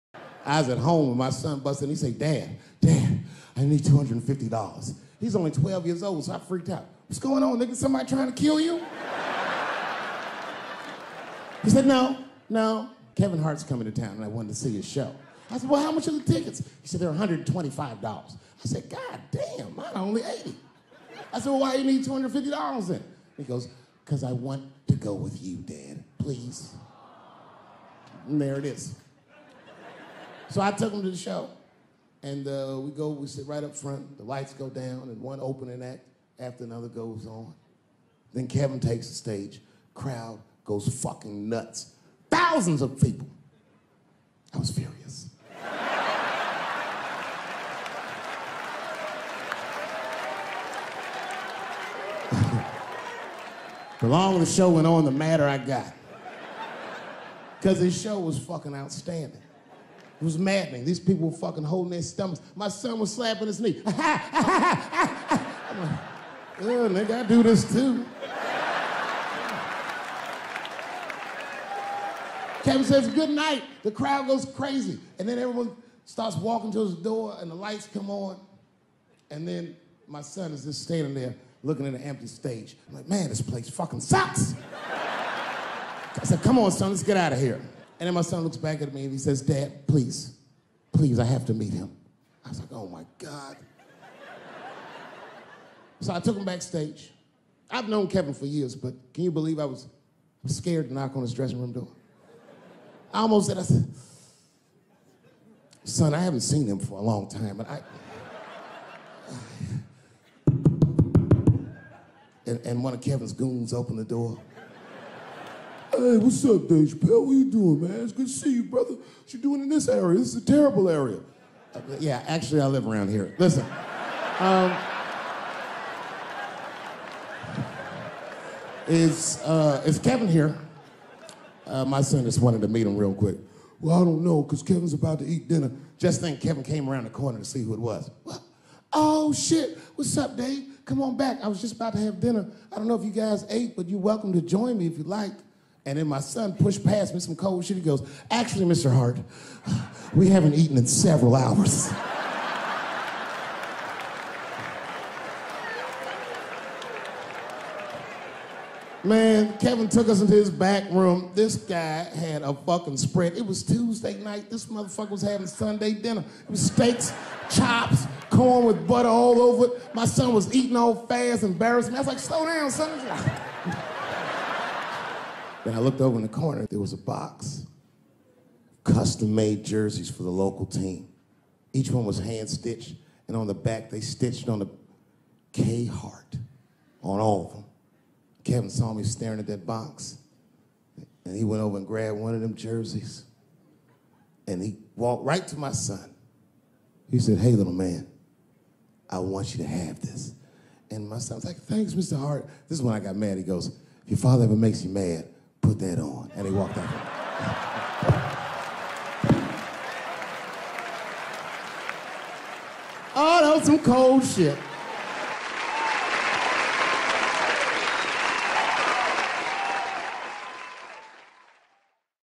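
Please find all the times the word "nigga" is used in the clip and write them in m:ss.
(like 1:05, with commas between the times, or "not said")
0:07, 1:06.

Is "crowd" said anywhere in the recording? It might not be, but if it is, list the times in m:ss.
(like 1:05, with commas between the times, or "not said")
0:39, 1:13.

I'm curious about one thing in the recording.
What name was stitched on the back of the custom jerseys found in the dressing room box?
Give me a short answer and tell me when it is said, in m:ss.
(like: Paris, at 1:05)
K Hart, at 3:05.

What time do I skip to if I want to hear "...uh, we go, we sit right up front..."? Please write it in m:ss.
0:32.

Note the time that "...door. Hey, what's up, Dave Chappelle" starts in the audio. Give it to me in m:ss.
1:54.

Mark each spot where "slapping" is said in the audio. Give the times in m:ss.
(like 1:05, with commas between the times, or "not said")
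1:03.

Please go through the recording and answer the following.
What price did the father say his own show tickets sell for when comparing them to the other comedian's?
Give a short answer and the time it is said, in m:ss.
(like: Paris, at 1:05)
80, at 0:20.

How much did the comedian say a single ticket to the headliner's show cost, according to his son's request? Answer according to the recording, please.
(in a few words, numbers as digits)
$125.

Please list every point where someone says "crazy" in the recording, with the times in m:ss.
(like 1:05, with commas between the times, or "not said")
1:14.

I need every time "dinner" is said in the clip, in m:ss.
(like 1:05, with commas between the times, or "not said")
2:15, 2:22, 2:45.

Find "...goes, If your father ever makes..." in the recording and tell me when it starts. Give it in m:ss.
3:23.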